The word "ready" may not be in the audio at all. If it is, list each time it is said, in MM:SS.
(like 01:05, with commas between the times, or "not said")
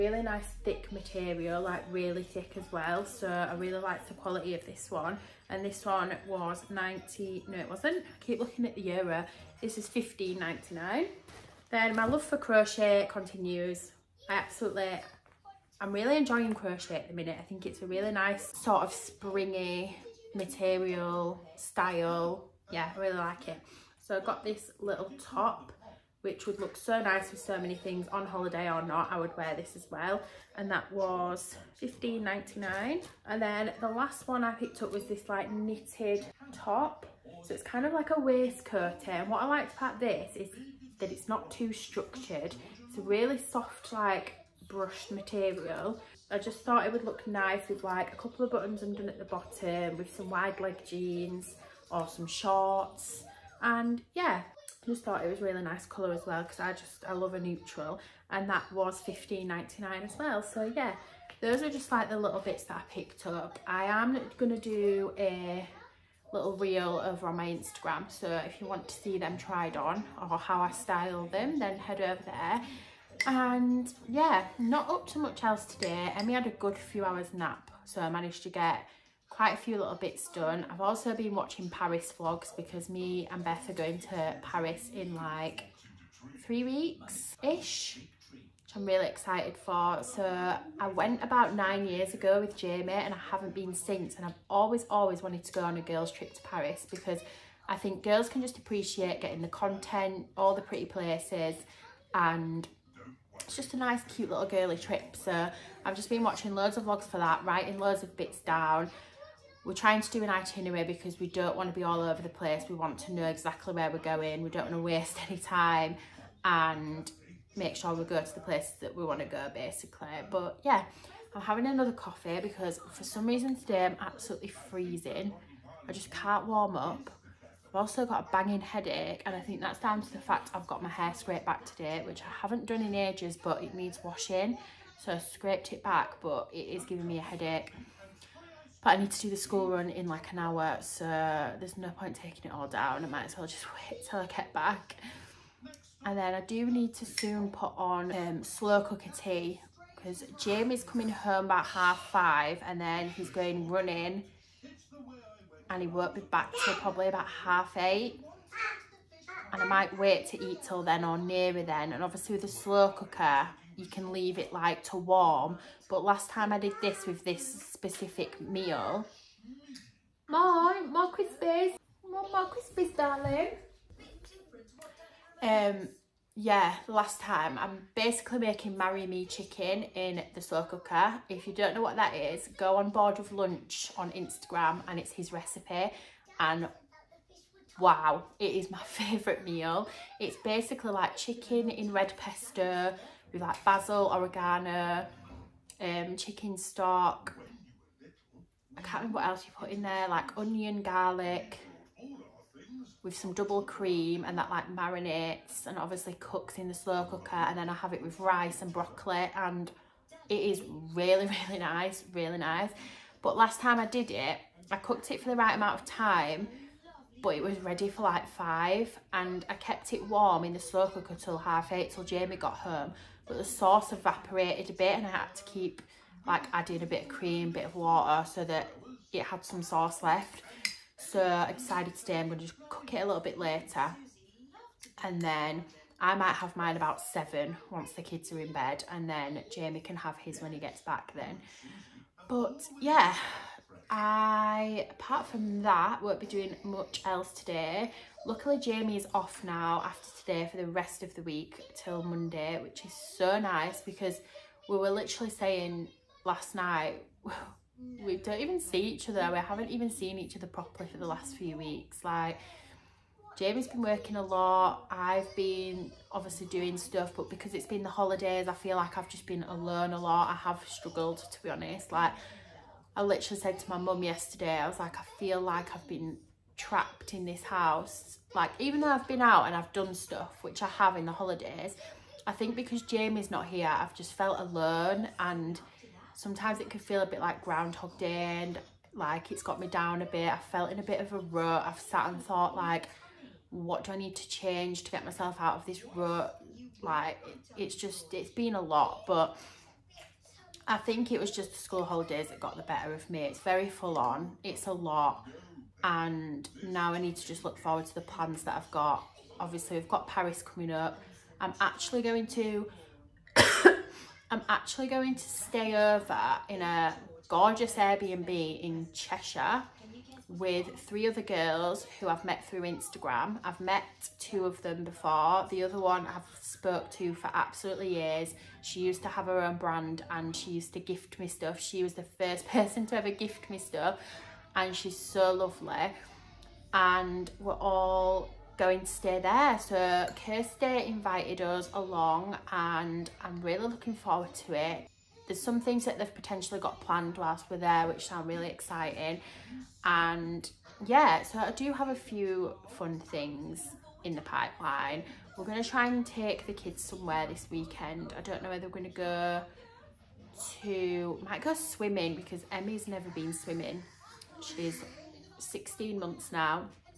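03:37.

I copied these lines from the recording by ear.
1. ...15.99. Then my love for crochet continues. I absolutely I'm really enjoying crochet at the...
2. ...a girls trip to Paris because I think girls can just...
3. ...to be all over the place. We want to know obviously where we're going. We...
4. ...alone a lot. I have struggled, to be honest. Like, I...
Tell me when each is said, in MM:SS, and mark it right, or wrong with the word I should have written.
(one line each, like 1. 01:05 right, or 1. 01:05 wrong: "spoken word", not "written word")
1. 00:09 right
2. 01:35 right
3. 01:51 wrong: "exactly", not "obviously"
4. 04:29 right.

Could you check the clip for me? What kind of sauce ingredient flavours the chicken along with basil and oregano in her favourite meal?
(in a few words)
Red pesto.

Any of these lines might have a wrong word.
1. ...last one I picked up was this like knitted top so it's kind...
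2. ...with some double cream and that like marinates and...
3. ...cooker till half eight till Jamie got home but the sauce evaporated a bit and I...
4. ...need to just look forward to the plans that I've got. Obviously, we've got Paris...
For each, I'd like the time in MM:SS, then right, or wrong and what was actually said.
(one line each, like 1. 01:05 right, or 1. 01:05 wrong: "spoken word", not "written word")
1. 00:33 right
2. 03:23 right
3. 03:40 right
4. 05:06 right.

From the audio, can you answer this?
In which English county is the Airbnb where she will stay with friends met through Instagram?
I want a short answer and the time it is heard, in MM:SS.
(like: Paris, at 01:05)
Cheshire, at 05:18.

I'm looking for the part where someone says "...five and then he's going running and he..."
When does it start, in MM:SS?
02:32.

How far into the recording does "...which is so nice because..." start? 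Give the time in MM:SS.
04:12.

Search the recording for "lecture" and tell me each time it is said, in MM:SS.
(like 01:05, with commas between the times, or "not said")
not said.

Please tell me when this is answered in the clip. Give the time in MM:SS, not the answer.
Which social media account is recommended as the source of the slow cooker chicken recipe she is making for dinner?
03:02.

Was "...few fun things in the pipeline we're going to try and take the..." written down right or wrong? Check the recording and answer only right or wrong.
right.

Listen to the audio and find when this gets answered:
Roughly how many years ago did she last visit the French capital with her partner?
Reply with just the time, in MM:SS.
01:31.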